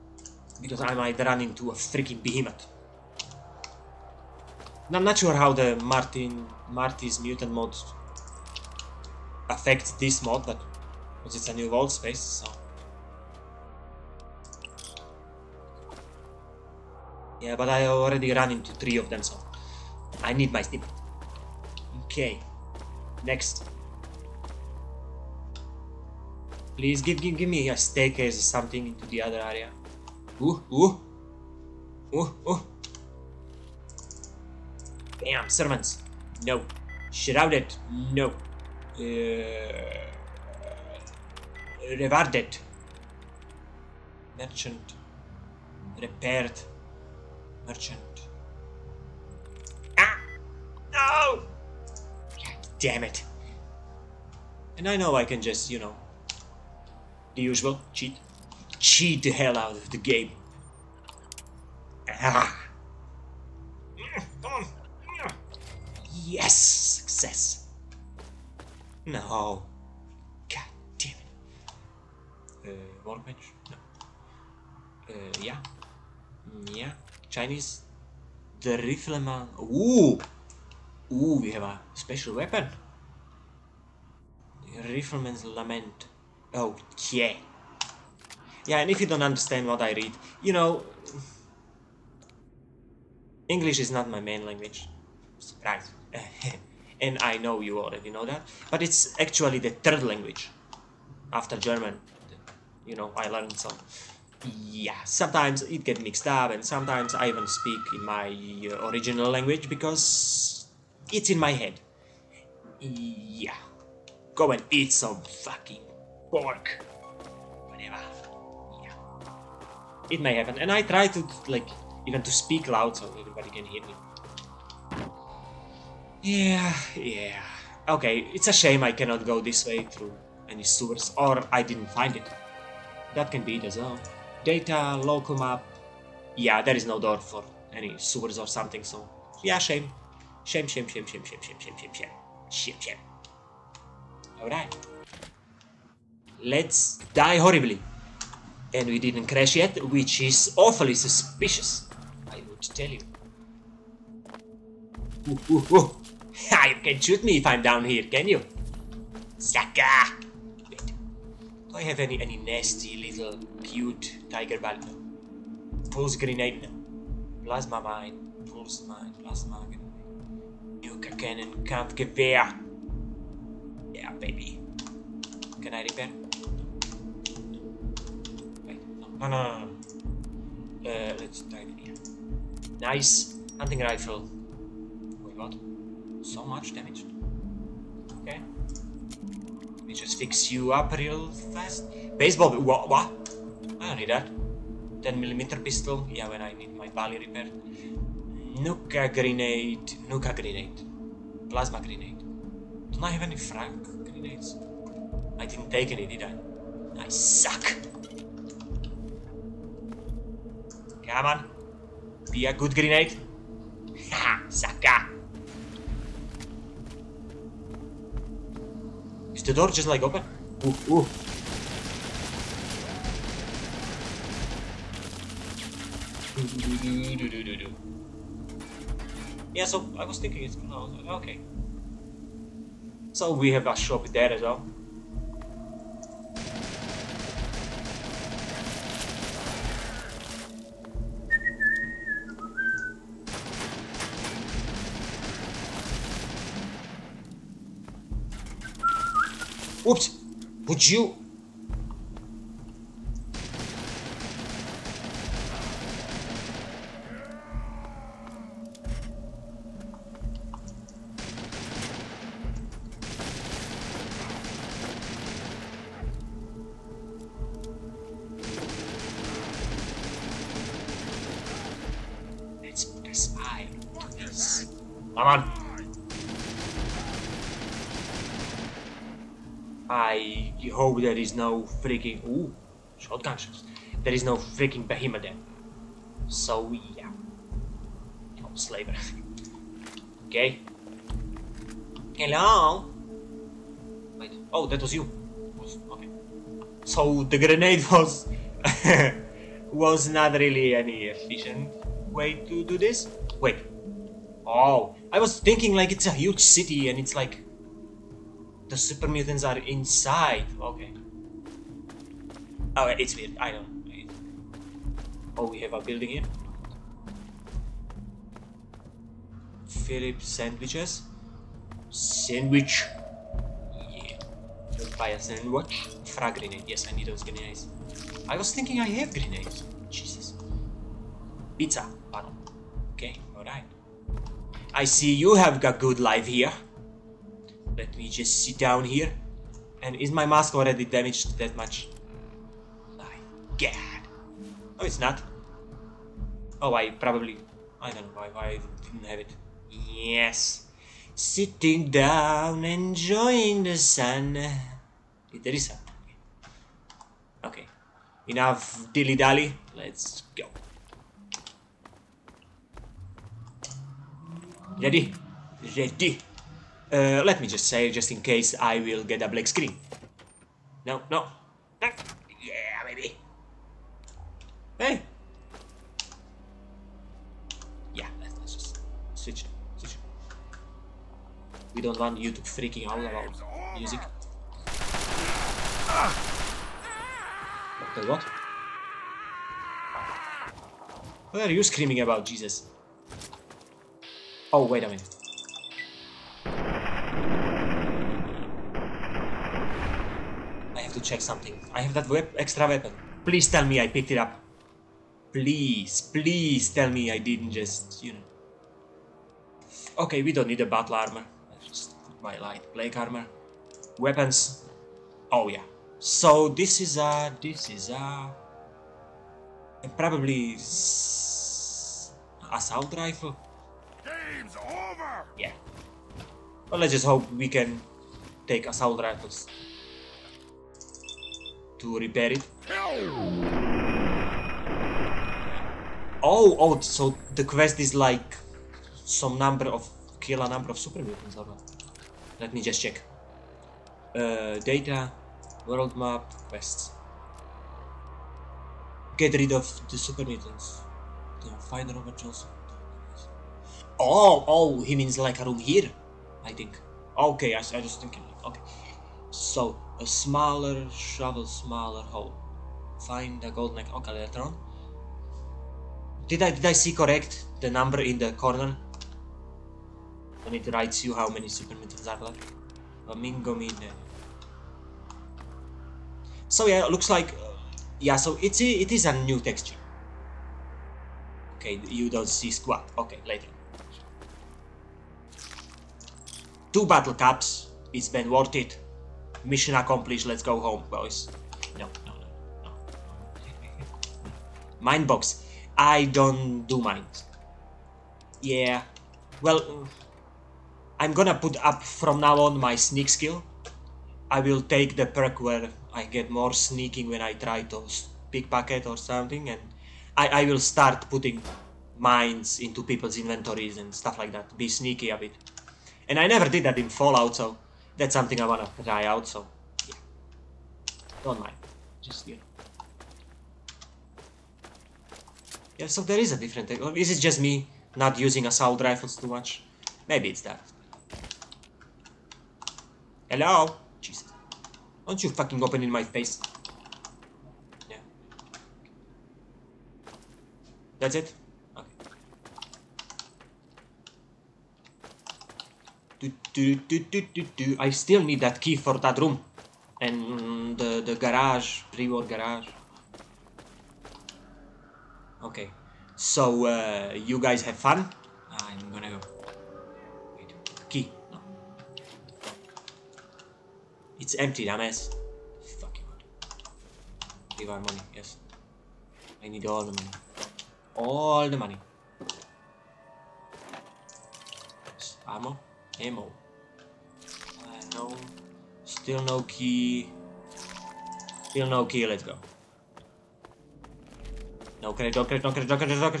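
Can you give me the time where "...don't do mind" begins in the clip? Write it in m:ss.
8:16.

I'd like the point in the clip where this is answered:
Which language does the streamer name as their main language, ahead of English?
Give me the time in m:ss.
1:41.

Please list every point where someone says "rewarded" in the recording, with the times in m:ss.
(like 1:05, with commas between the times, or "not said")
0:41.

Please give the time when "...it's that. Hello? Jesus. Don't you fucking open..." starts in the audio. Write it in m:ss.
8:50.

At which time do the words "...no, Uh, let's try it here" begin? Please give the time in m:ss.
2:59.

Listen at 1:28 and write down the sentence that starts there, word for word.
Yeah, and if you don't understand what I read, you know...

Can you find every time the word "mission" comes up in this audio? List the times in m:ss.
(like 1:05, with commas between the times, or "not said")
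8:09.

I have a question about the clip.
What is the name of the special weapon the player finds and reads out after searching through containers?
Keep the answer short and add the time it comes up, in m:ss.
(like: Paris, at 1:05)
Rifleman's Lament, at 1:24.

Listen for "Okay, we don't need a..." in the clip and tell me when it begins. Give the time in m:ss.
6:49.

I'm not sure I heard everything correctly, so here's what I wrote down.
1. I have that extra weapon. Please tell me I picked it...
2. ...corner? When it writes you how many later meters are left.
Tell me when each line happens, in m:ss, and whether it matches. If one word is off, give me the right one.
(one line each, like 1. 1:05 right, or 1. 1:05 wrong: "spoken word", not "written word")
1. 6:41 right
2. 7:48 wrong: "super", not "later".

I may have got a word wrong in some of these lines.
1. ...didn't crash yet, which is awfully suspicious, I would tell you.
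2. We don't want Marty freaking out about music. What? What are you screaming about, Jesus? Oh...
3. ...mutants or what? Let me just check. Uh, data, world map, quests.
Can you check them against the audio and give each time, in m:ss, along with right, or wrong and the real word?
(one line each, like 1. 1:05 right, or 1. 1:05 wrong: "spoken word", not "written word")
1. 2:28 right
2. 6:21 wrong: "YouTube", not "Marty"
3. 7:21 right.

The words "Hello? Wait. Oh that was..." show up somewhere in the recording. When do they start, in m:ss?
4:52.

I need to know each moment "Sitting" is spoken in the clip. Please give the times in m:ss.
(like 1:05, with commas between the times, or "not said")
5:51.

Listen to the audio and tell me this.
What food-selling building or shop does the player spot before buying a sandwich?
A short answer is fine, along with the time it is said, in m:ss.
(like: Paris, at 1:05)
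Philip sandwiches, at 5:19.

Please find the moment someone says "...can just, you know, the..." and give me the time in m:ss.
0:55.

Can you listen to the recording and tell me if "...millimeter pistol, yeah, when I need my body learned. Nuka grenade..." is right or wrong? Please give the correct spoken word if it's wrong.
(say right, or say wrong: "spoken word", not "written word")
wrong: "repaired", not "learned".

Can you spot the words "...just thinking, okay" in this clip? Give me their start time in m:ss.
7:37.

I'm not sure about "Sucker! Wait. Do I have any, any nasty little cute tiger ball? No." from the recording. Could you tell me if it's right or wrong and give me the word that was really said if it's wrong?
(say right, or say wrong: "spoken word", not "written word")
right.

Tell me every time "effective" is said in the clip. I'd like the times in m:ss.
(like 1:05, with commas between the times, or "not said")
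not said.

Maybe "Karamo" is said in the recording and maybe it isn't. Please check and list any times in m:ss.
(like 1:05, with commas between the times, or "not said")
not said.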